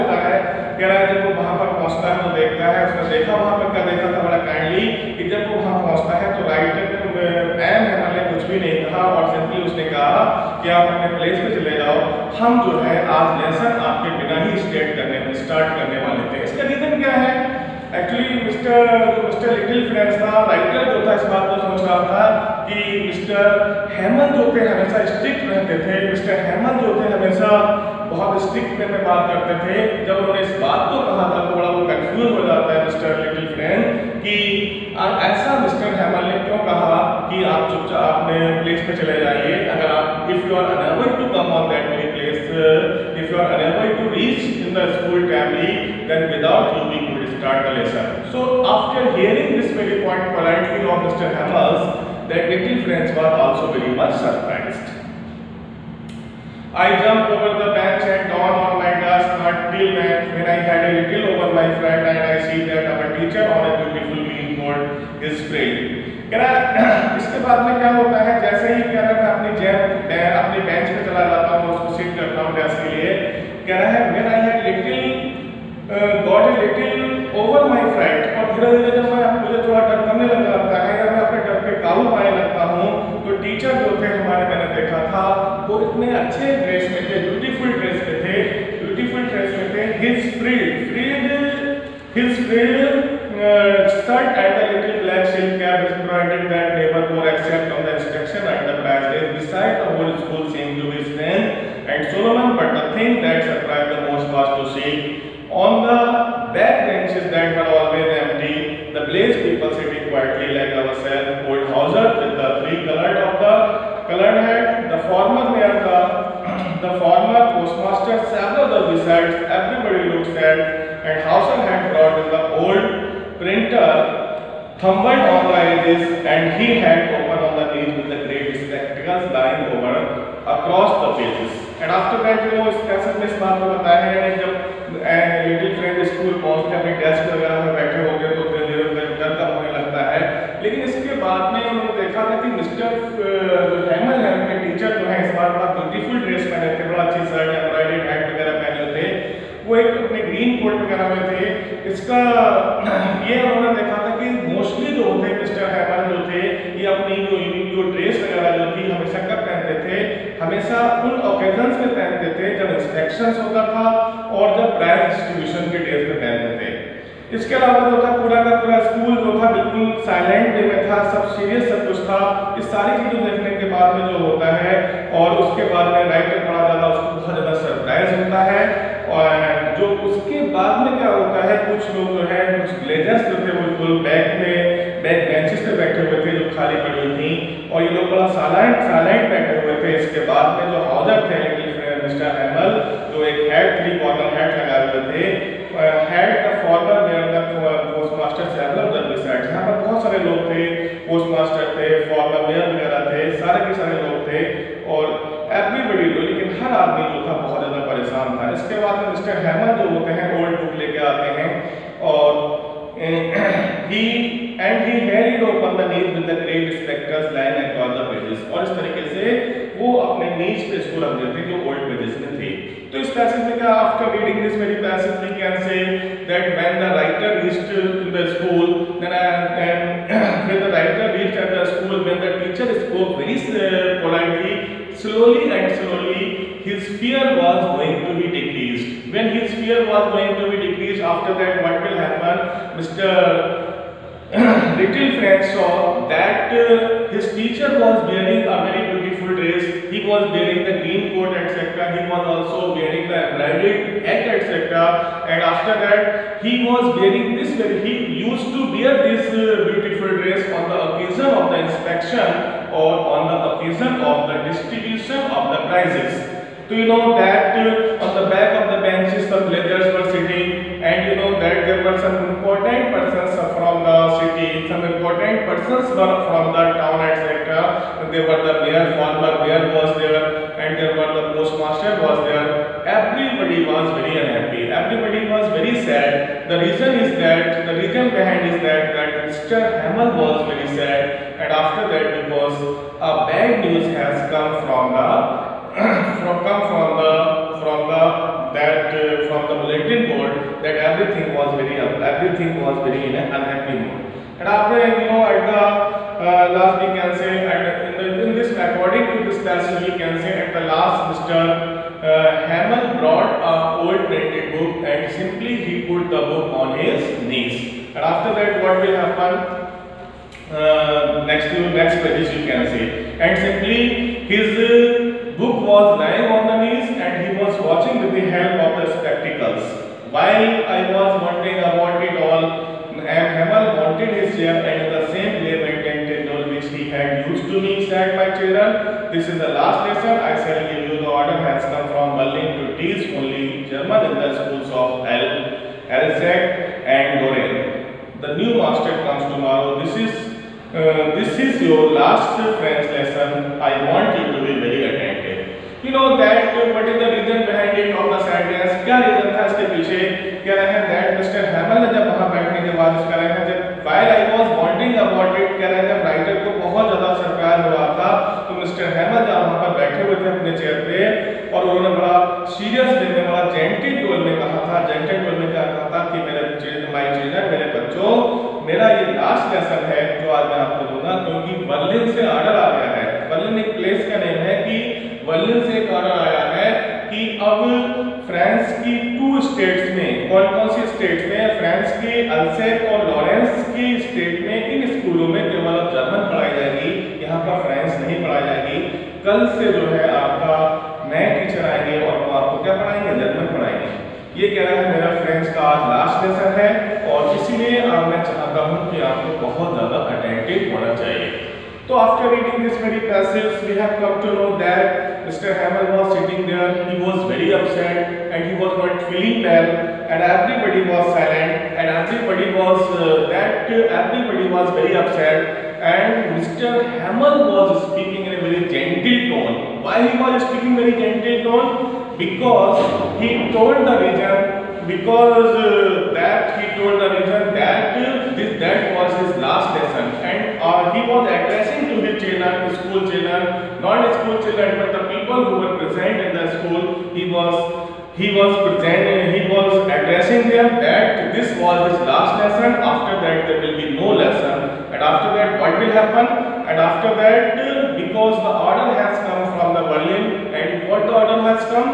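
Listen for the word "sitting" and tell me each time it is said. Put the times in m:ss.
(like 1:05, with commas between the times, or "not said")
1:49, 4:30.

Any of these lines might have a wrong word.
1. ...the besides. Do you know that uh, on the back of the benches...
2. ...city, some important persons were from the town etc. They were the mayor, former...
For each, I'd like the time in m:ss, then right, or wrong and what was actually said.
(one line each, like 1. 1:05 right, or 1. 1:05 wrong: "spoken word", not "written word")
1. 4:25 wrong: "prizes", not "besides"
2. 4:34 right.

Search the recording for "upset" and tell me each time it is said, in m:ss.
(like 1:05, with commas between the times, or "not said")
6:57, 7:04.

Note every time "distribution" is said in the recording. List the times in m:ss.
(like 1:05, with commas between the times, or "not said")
4:24.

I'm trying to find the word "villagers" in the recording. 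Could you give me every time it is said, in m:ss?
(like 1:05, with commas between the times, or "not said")
4:29.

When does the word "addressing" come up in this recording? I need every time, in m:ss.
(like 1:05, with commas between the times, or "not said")
7:21, 7:29.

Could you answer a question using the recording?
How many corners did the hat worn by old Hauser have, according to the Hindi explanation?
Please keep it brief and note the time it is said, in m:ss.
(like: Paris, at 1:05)
3, at 3:13.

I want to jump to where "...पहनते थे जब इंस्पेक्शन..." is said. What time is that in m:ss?
2:41.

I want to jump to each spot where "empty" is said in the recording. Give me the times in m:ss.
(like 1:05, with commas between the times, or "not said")
1:48.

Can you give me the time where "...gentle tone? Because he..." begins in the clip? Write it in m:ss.
7:10.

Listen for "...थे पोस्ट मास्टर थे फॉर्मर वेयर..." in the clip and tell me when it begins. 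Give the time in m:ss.
3:20.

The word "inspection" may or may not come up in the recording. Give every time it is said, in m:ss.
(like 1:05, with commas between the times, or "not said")
1:37, 4:21.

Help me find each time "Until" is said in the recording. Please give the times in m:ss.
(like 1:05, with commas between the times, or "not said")
0:59.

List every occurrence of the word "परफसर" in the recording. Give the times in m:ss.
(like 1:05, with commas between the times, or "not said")
6:01.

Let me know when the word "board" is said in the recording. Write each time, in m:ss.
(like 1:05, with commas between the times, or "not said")
1:04, 5:00.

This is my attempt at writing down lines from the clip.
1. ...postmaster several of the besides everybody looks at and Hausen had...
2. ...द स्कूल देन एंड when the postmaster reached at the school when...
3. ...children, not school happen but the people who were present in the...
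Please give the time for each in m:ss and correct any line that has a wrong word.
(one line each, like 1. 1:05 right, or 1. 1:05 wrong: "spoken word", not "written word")
1. 1:57 right
2. 3:48 wrong: "writer", not "postmaster"
3. 7:23 wrong: "children", not "happen".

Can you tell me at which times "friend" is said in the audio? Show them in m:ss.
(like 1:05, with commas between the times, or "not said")
1:01, 4:05.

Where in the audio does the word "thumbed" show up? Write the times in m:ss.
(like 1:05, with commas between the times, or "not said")
2:04.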